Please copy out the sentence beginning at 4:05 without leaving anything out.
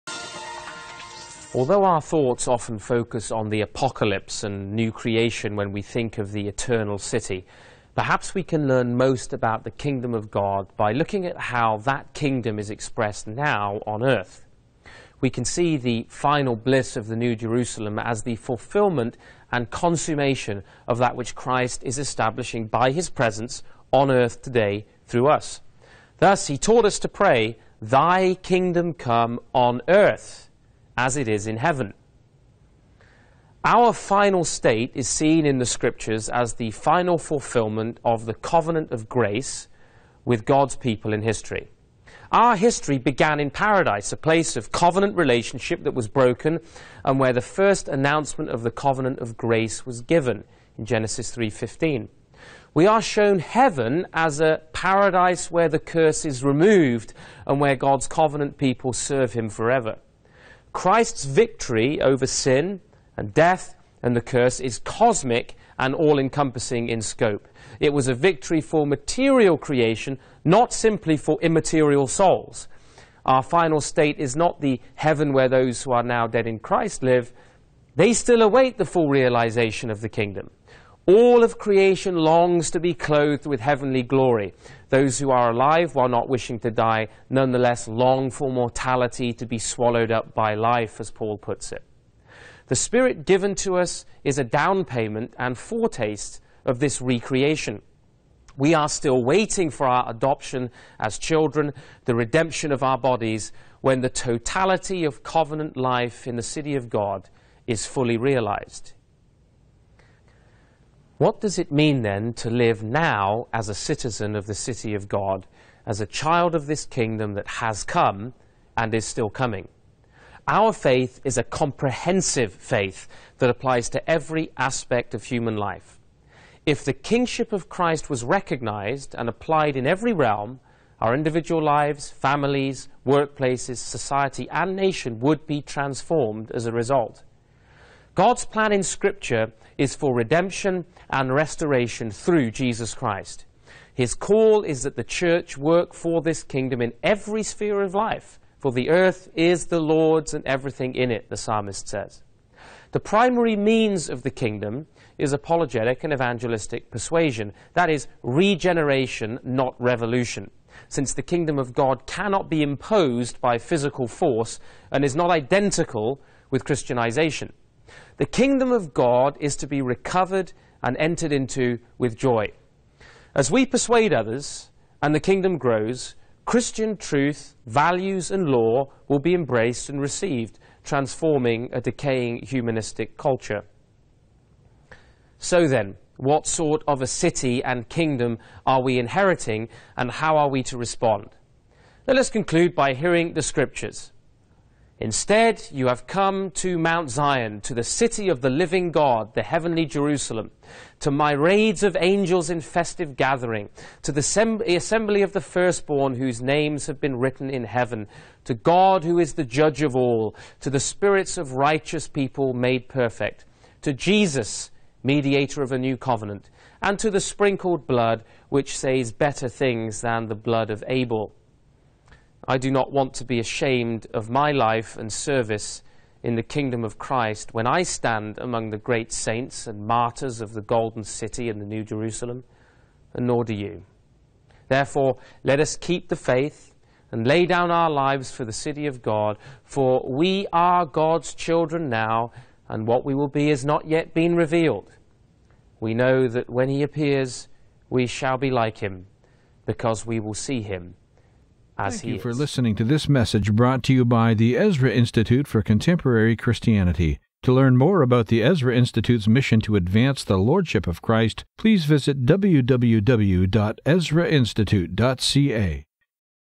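We know that when he appears, we shall be like him, because we will see him Thank you is.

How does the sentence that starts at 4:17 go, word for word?
To learn more about the Ezra Institute's mission to advance the Lordship of Christ, please visit www.ezrainstitute.ca.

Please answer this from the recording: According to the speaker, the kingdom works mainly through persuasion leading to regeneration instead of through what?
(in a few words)
Revolution.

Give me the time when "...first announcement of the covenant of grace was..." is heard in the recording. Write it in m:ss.
0:47.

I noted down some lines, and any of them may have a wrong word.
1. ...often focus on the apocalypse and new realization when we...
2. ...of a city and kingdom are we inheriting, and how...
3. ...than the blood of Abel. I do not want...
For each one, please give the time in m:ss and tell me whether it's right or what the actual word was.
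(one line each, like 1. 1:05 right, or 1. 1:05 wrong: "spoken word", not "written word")
1. 0:02 wrong: "creation", not "realization"
2. 3:06 right
3. 3:40 right.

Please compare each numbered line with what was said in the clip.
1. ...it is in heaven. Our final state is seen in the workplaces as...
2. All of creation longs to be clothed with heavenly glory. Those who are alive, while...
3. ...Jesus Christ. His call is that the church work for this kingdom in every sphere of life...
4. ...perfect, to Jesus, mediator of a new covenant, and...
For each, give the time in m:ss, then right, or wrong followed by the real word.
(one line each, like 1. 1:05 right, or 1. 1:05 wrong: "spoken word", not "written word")
1. 0:31 wrong: "scriptures", not "workplaces"
2. 1:21 right
3. 2:22 right
4. 3:32 right.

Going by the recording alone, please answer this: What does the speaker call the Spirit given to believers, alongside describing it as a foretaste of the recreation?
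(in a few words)
A down payment.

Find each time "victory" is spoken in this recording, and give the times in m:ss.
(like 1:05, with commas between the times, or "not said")
1:01, 1:08.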